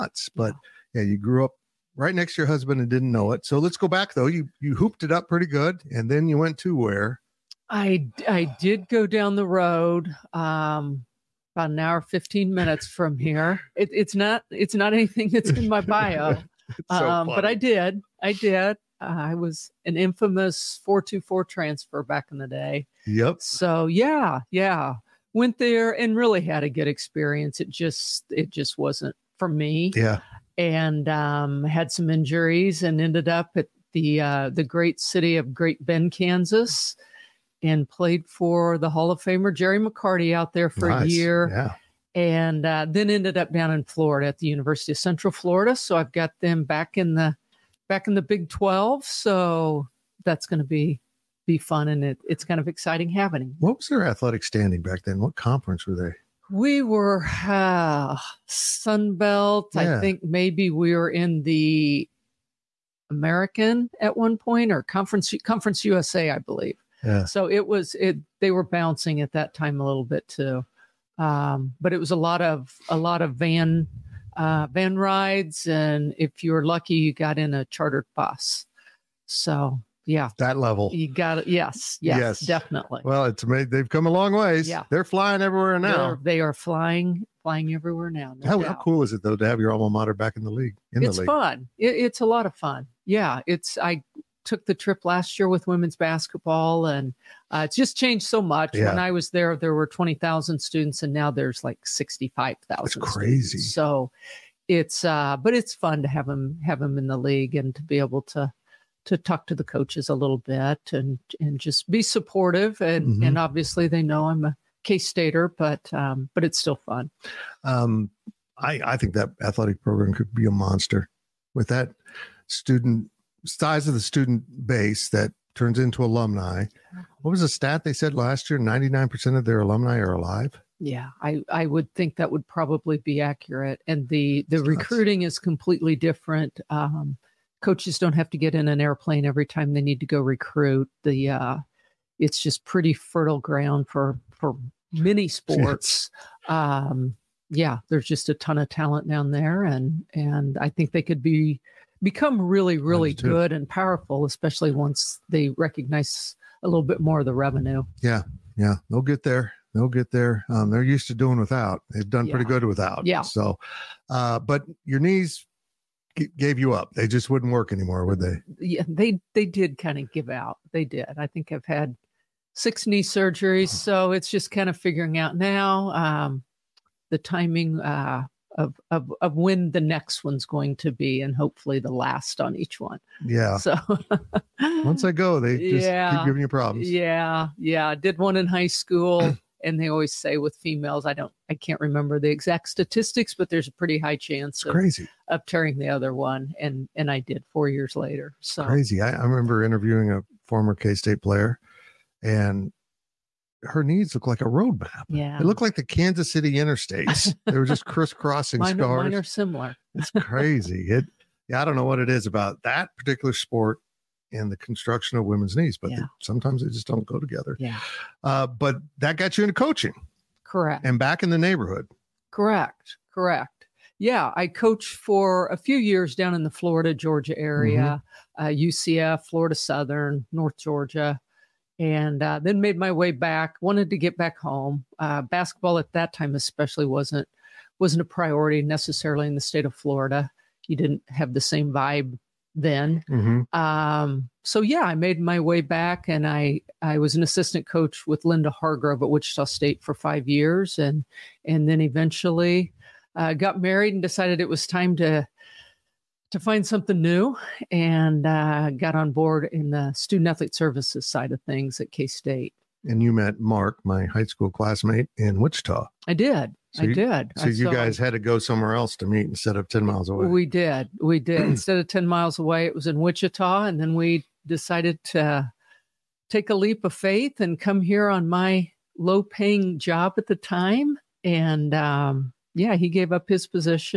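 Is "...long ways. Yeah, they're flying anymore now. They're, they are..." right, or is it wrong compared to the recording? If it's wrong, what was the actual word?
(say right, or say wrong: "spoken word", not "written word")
wrong: "everywhere", not "anymore".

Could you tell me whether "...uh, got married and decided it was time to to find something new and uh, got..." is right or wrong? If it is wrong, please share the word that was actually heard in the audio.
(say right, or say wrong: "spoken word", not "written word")
right.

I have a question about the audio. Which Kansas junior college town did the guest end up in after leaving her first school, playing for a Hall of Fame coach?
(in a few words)
Great Bend, Kansas.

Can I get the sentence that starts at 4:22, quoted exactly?
And you met Mark, my high school classmate in Wichita.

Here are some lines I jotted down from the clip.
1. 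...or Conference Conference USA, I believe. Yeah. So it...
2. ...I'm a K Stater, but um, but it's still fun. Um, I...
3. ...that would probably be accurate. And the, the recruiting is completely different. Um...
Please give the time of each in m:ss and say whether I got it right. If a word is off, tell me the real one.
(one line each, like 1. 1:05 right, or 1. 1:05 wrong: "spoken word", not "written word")
1. 1:04 right
2. 1:54 right
3. 2:12 right.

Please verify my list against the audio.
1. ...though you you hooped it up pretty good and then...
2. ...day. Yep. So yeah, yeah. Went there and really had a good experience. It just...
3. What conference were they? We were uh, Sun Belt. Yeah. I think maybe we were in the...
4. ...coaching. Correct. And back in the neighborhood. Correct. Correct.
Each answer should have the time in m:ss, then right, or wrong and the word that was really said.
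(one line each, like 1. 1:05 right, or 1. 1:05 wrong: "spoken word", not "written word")
1. 0:04 right
2. 0:22 right
3. 0:55 right
4. 3:39 right.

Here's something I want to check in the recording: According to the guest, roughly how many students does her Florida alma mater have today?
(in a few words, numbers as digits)
65,000.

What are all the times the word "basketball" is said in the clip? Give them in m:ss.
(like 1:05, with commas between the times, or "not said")
1:35, 3:55.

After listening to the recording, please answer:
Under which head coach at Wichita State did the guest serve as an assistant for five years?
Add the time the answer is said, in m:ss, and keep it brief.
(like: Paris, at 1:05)
Linda Hargrove, at 4:08.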